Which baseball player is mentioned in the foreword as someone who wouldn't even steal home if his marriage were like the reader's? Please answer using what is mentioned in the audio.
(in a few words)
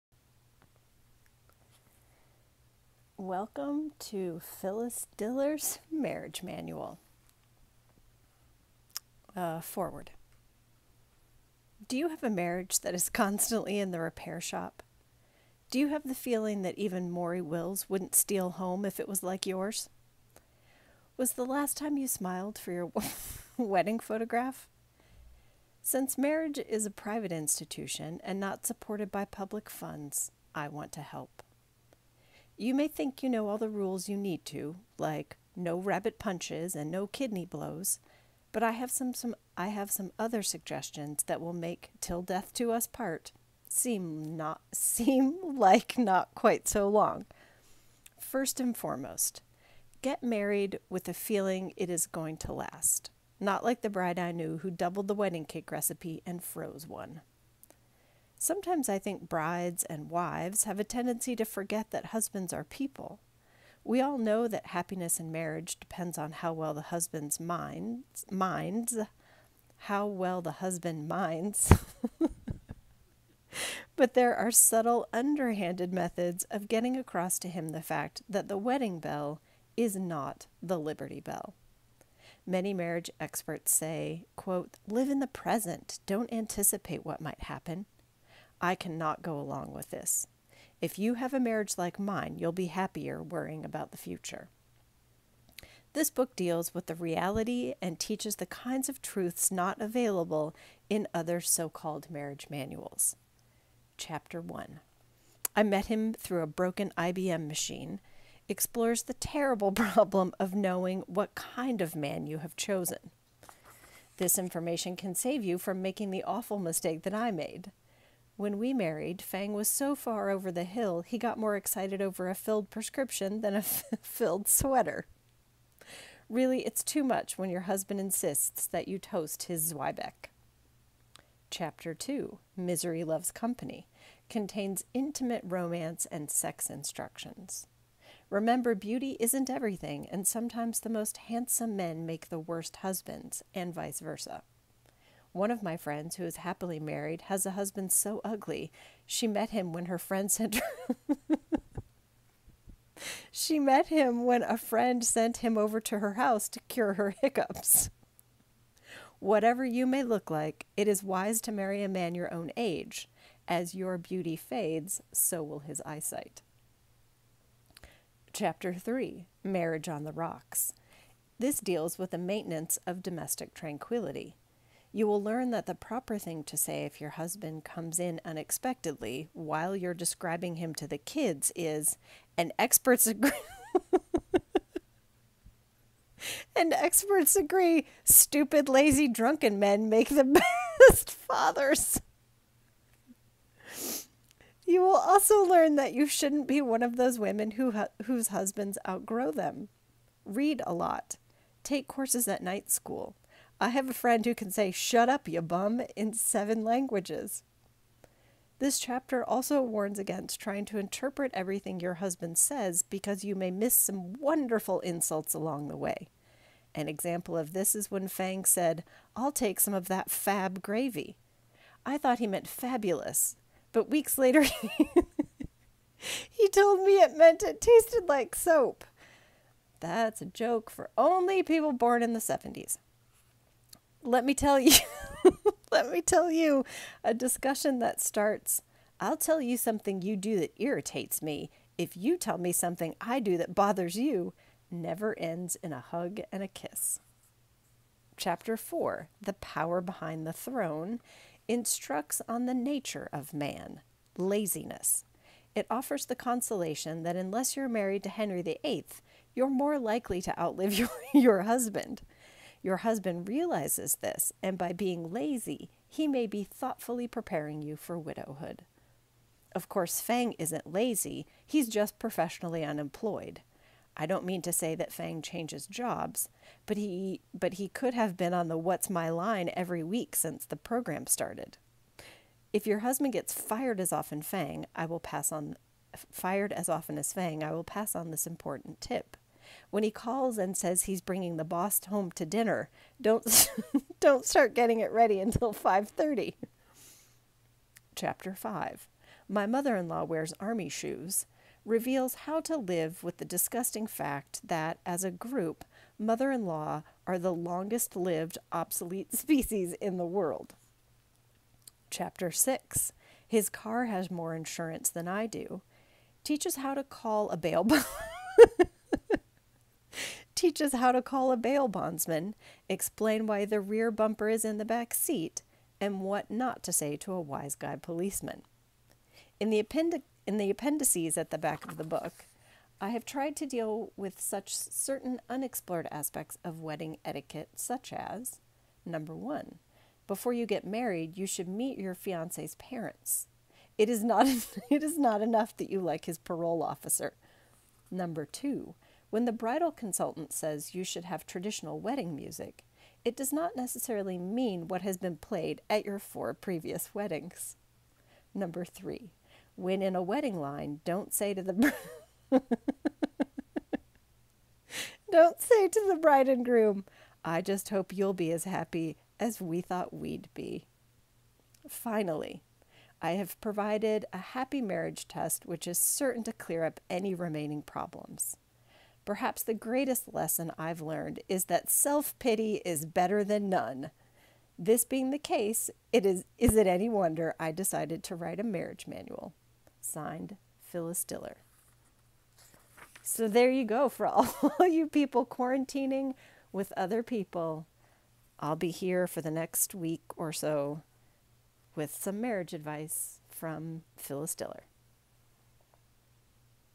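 Maury Wills.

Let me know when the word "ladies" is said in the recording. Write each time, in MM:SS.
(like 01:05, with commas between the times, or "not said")
not said.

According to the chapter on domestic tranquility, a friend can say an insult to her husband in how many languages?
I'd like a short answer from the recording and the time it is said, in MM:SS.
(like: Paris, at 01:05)
7, at 03:26.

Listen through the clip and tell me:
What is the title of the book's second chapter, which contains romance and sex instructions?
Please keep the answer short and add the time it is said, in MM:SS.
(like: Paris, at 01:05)
Misery Loves Company, at 02:12.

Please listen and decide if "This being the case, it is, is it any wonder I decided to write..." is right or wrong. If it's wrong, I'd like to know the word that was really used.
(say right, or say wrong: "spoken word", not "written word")
right.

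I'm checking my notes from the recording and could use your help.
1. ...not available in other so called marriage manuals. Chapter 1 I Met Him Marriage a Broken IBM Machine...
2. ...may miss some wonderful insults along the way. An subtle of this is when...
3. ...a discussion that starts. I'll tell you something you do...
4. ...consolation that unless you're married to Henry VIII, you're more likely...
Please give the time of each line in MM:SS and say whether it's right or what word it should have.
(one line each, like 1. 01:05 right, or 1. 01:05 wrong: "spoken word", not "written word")
1. 01:39 wrong: "Through", not "Marriage"
2. 03:33 wrong: "example", not "subtle"
3. 03:57 right
4. 04:16 right.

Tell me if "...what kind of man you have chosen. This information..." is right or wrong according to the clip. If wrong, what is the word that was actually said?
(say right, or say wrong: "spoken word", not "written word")
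right.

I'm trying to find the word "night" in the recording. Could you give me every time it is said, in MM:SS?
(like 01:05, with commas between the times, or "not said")
03:22.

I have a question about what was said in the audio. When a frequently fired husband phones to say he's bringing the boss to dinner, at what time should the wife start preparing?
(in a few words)
5:30.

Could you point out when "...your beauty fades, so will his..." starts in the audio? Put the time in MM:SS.
02:43.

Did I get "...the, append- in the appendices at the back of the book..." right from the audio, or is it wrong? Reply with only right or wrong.
right.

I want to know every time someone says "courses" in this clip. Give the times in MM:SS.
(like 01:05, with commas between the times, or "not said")
03:21, 04:29.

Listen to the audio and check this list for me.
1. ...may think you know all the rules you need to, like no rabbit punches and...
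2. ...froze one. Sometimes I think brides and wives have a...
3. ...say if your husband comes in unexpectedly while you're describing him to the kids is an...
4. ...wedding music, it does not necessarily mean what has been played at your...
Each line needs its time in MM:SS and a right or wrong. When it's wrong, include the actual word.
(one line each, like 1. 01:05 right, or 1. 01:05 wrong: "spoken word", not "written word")
1. 00:32 right
2. 00:56 right
3. 02:56 right
4. 05:51 right.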